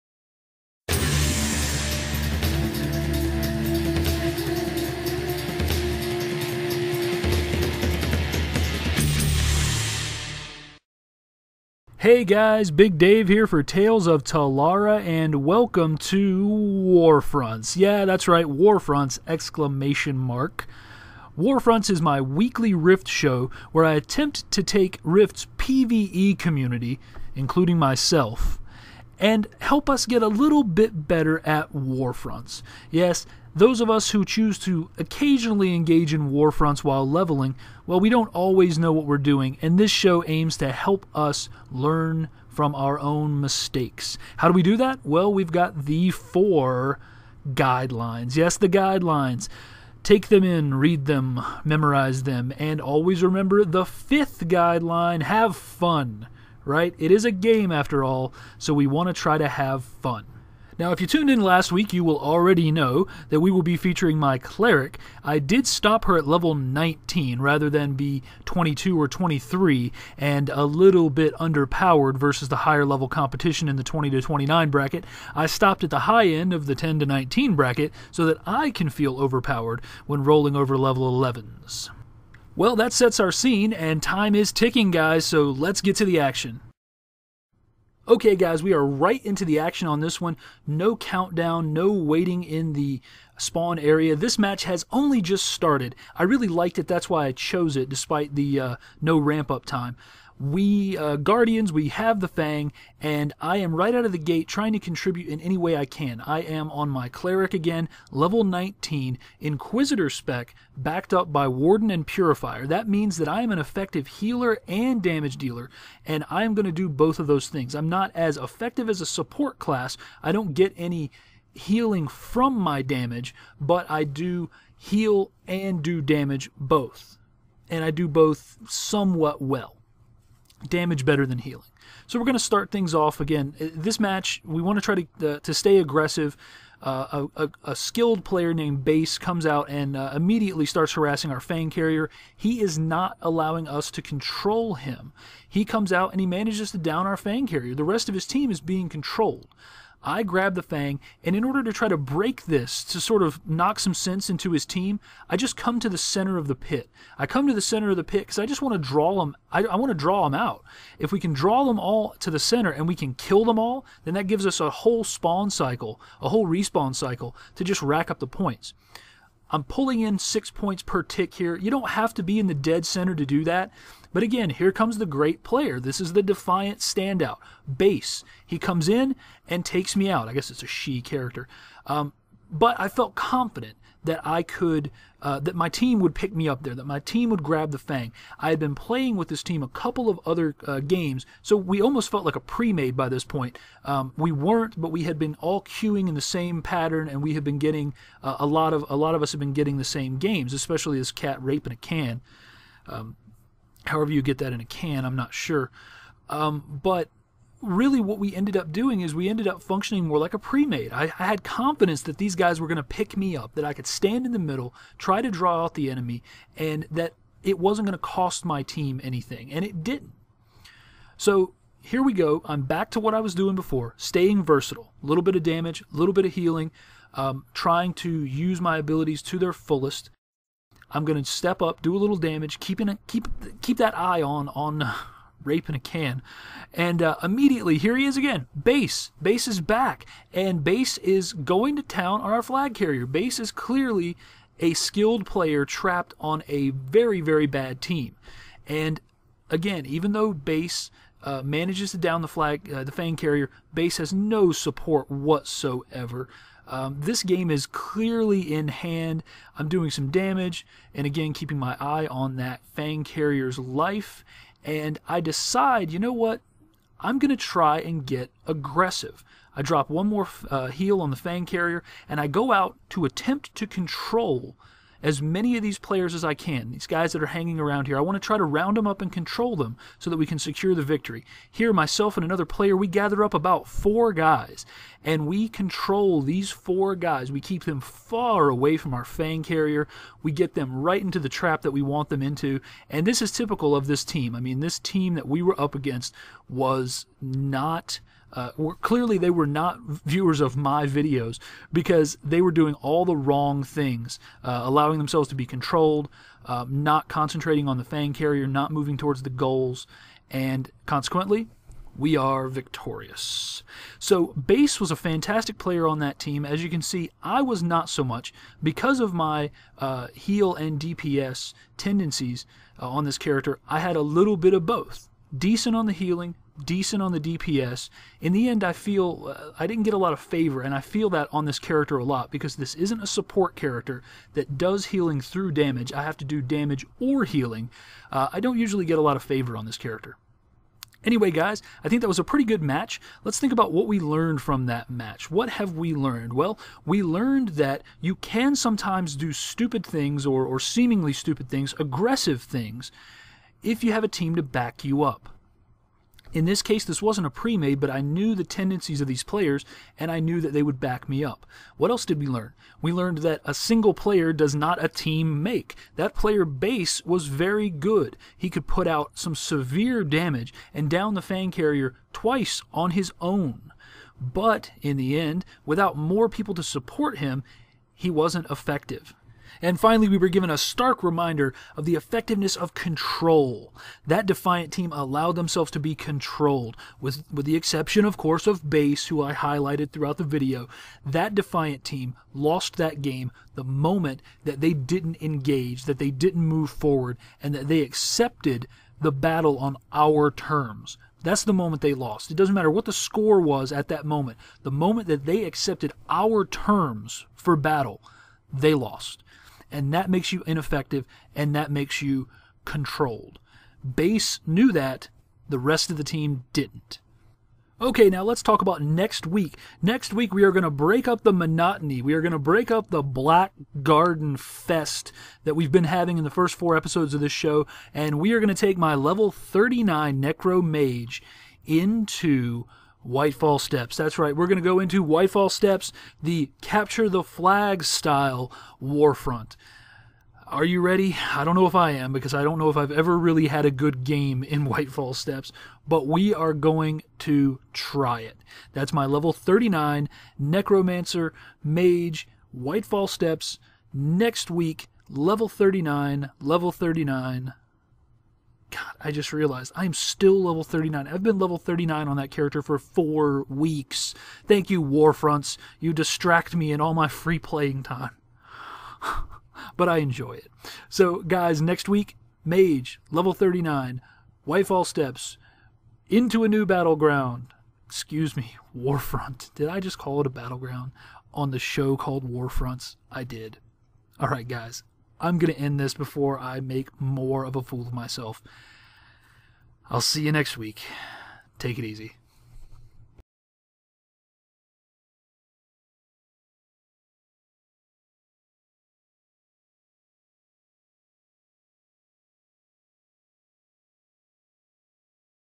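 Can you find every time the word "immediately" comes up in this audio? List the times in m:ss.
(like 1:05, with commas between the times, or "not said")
2:20, 3:57.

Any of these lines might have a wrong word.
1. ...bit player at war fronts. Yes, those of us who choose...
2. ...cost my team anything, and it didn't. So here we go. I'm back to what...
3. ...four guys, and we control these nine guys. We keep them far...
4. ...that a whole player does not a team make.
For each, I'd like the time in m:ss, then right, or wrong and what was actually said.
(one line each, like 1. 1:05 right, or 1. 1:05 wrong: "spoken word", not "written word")
1. 0:30 wrong: "better", not "player"
2. 3:37 right
3. 4:43 wrong: "four", not "nine"
4. 6:03 wrong: "single", not "whole".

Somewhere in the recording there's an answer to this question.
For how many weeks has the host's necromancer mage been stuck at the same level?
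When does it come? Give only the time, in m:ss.
7:42.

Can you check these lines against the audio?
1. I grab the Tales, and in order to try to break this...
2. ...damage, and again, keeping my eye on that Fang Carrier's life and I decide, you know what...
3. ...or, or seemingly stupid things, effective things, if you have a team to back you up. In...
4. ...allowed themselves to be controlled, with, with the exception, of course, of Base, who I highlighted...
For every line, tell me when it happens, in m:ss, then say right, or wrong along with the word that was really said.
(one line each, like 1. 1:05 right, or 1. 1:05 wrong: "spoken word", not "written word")
1. 2:30 wrong: "Fang", not "Tales"
2. 4:20 right
3. 5:50 wrong: "aggressive", not "effective"
4. 6:24 right.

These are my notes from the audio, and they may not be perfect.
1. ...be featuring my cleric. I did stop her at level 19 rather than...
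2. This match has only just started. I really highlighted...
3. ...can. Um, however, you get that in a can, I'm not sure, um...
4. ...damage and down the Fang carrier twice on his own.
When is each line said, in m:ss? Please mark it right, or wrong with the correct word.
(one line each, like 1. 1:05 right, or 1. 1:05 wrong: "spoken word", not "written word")
1. 1:03 right
2. 1:34 wrong: "liked", not "highlighted"
3. 3:21 right
4. 6:10 right.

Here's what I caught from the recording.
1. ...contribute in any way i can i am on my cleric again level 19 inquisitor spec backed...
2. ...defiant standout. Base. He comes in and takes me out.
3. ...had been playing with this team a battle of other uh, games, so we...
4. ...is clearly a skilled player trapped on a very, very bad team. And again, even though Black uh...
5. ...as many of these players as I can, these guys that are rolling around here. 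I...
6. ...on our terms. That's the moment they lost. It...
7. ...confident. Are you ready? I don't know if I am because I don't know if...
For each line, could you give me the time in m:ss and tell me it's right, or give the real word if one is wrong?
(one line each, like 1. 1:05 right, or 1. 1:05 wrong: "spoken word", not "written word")
1. 1:44 right
2. 2:56 right
3. 3:08 wrong: "couple", not "battle"
4. 4:03 wrong: "Base", not "Black"
5. 4:35 wrong: "hanging", not "rolling"
6. 6:39 right
7. 7:18 wrong: "warfront", not "confident".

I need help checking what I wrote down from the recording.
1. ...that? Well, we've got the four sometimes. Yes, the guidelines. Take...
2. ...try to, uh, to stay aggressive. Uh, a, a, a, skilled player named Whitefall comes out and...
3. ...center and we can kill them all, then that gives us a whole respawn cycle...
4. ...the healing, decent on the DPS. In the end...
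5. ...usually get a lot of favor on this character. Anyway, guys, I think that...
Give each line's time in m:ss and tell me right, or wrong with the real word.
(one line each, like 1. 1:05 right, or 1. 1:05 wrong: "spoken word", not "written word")
1. 0:44 wrong: "guidelines", not "sometimes"
2. 2:14 wrong: "Base", not "Whitefall"
3. 2:42 wrong: "spawn", not "respawn"
4. 5:25 right
5. 5:38 right.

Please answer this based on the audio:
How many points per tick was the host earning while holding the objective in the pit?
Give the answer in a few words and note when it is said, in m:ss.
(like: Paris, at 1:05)
6, at 2:50.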